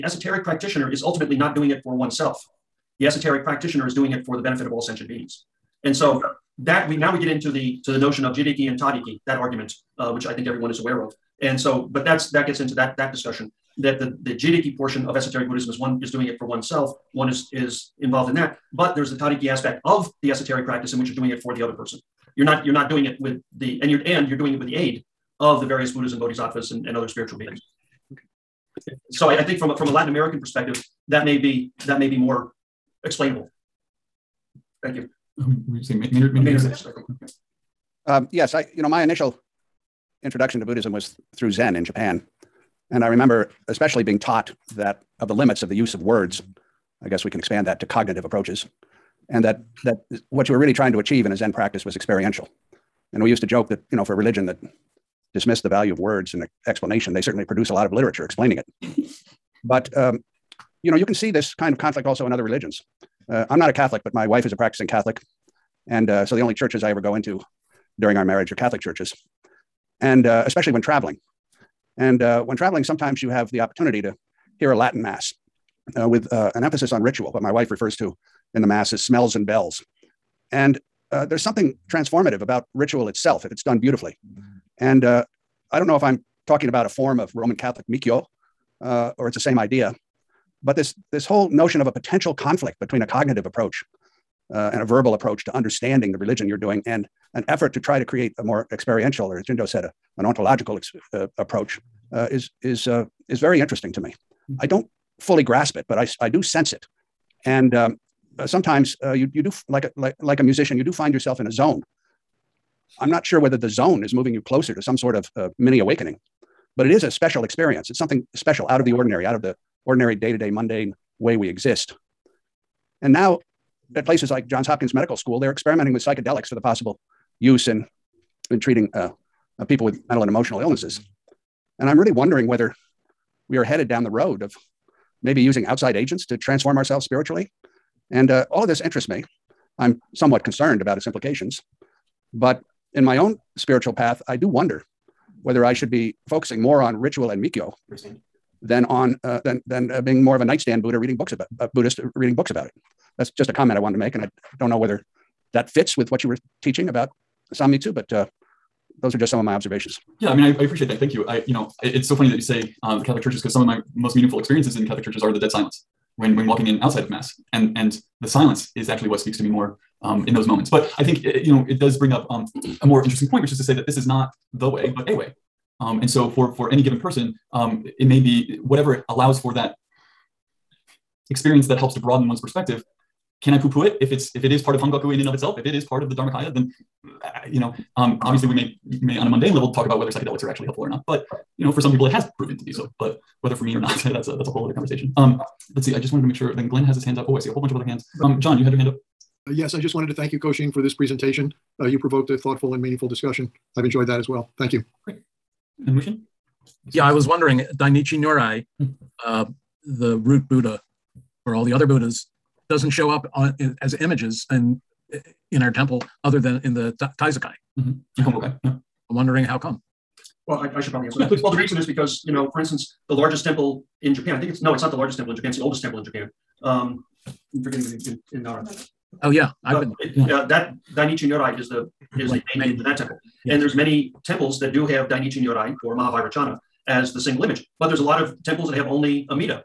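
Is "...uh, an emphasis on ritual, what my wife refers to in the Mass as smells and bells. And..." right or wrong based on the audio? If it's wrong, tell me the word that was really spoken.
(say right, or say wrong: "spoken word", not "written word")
right.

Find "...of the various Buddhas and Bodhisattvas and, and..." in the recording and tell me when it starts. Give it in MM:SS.
00:25.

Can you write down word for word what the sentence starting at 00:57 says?
They certainly produce a lot of literature explaining it.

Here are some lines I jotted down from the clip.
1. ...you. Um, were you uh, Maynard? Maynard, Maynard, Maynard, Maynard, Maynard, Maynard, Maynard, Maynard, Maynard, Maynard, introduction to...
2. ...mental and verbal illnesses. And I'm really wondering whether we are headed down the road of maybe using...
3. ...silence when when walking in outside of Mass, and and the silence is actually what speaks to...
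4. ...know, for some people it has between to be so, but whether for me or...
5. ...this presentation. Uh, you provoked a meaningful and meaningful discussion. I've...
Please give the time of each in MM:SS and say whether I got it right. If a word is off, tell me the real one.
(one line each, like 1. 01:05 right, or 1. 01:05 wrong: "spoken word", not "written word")
1. 00:34 right
2. 02:10 wrong: "emotional", not "verbal"
3. 02:45 right
4. 03:11 wrong: "proven", not "between"
5. 03:20 wrong: "thoughtful", not "meaningful".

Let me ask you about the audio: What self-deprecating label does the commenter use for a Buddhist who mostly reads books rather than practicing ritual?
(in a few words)
nightstand Buddha.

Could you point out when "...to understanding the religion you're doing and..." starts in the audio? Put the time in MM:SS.
01:35.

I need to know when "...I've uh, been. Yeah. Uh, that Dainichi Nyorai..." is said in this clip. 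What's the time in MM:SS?
03:49.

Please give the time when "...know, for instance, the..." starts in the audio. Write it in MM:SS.
03:42.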